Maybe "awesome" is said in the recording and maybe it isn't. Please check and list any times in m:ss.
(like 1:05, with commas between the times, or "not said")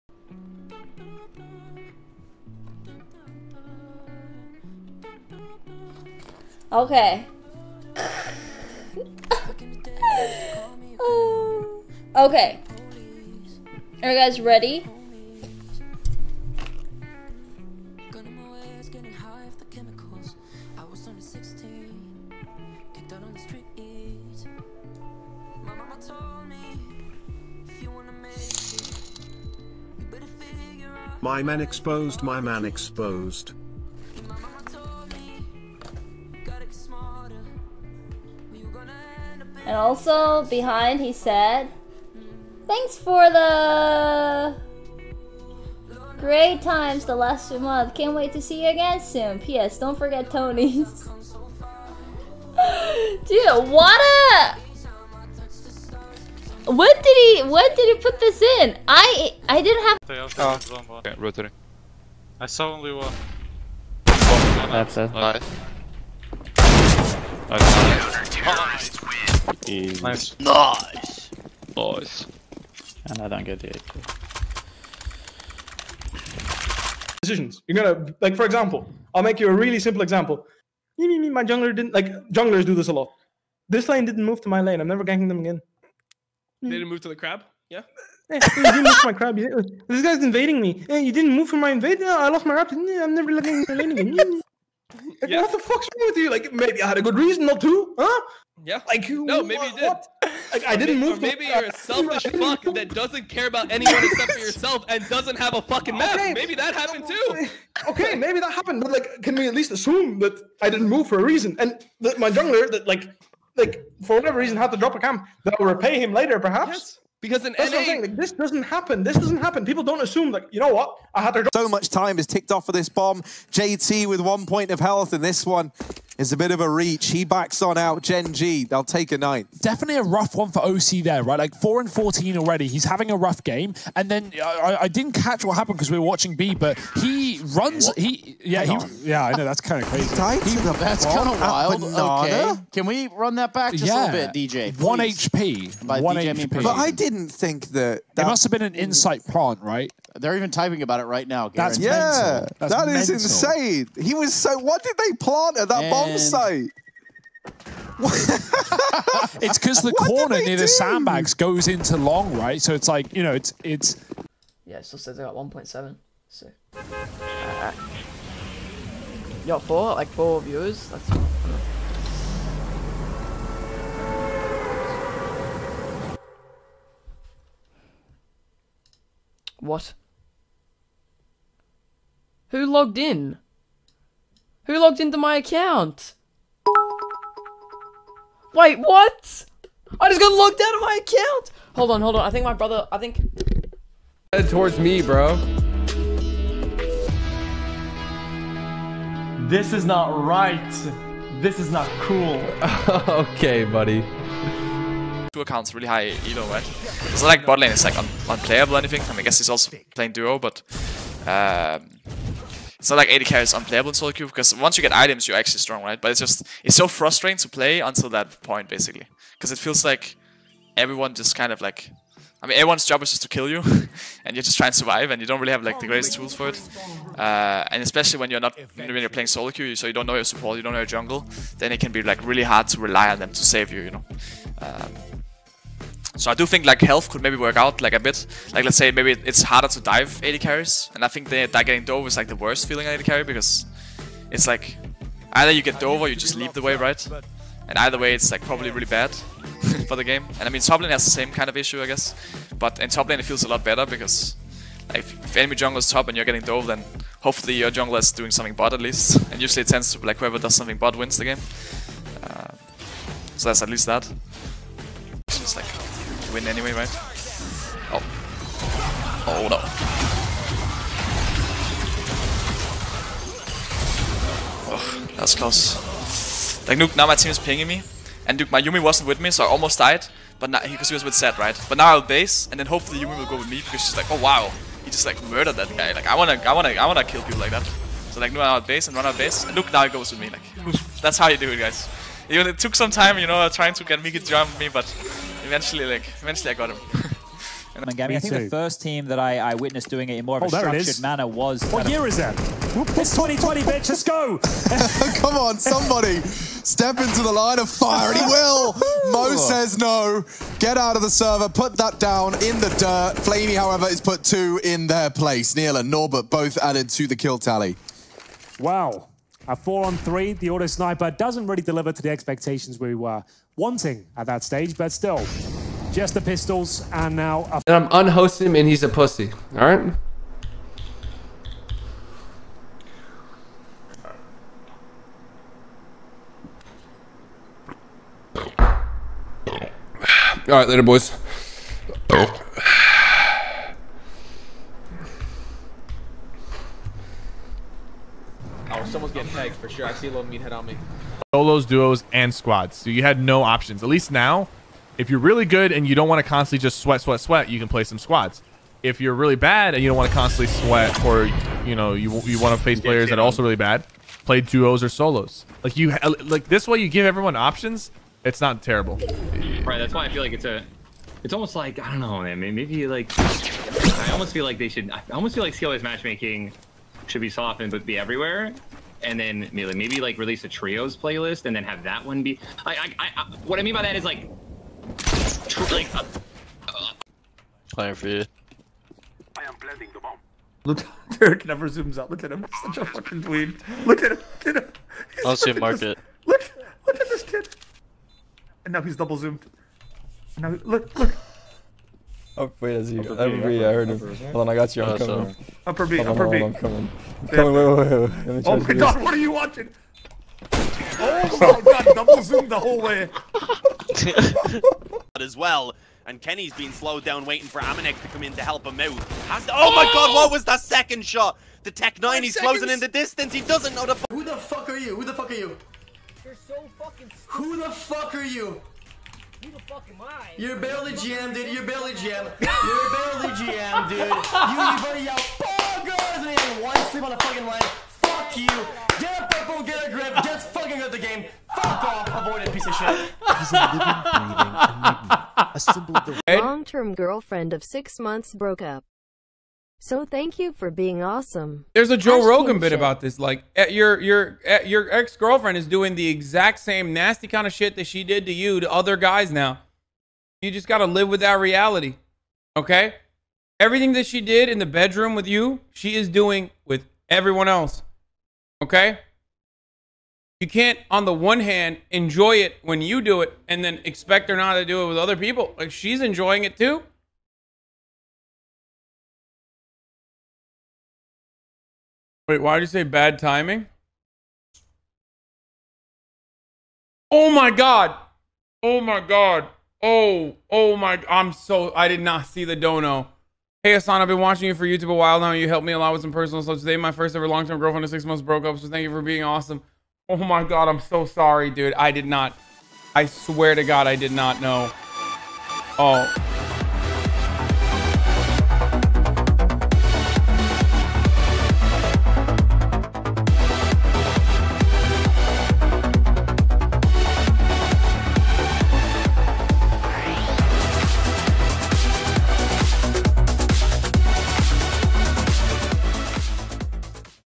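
7:31, 8:19.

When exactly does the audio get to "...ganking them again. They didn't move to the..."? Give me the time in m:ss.
1:25.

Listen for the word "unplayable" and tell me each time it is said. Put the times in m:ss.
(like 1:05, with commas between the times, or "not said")
3:28, 3:33.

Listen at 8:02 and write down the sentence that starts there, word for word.
Wait, why did you say bad timing?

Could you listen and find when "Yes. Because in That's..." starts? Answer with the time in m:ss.
1:56.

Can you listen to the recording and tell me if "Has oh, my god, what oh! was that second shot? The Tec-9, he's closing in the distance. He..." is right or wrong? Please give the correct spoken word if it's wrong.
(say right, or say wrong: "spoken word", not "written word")
right.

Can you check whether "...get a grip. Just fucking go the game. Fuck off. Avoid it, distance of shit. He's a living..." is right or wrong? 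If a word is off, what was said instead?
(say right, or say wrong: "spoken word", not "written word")
wrong: "piece", not "distance".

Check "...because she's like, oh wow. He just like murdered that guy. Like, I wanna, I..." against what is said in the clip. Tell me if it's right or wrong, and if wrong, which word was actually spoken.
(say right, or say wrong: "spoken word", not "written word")
right.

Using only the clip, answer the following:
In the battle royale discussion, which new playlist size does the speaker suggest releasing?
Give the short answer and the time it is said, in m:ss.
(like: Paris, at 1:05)
trios, at 6:20.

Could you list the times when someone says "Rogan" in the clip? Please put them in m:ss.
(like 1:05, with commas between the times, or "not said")
7:32.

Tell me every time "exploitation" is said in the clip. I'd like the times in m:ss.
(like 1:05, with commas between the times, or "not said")
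not said.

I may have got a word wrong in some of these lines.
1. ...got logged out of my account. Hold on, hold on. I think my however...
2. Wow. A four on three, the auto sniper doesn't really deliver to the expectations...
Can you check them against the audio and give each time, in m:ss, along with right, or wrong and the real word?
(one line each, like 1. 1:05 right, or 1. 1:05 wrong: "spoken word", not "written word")
1. 3:10 wrong: "brother", not "however"
2. 5:18 right.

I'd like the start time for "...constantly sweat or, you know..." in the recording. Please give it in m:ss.
6:00.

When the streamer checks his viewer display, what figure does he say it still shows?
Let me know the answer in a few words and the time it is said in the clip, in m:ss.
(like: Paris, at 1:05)
1.7, at 2:45.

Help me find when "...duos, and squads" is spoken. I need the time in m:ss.
5:51.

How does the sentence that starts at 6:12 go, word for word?
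Maybe like I almost feel like they should.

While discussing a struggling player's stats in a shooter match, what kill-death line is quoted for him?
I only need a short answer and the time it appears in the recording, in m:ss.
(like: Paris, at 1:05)
4 and 14, at 2:11.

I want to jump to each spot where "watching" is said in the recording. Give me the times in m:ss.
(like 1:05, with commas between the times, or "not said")
2:16, 6:49, 8:14.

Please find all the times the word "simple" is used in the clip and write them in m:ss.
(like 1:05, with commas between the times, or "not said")
1:19.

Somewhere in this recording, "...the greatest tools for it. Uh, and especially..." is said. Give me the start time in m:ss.
3:45.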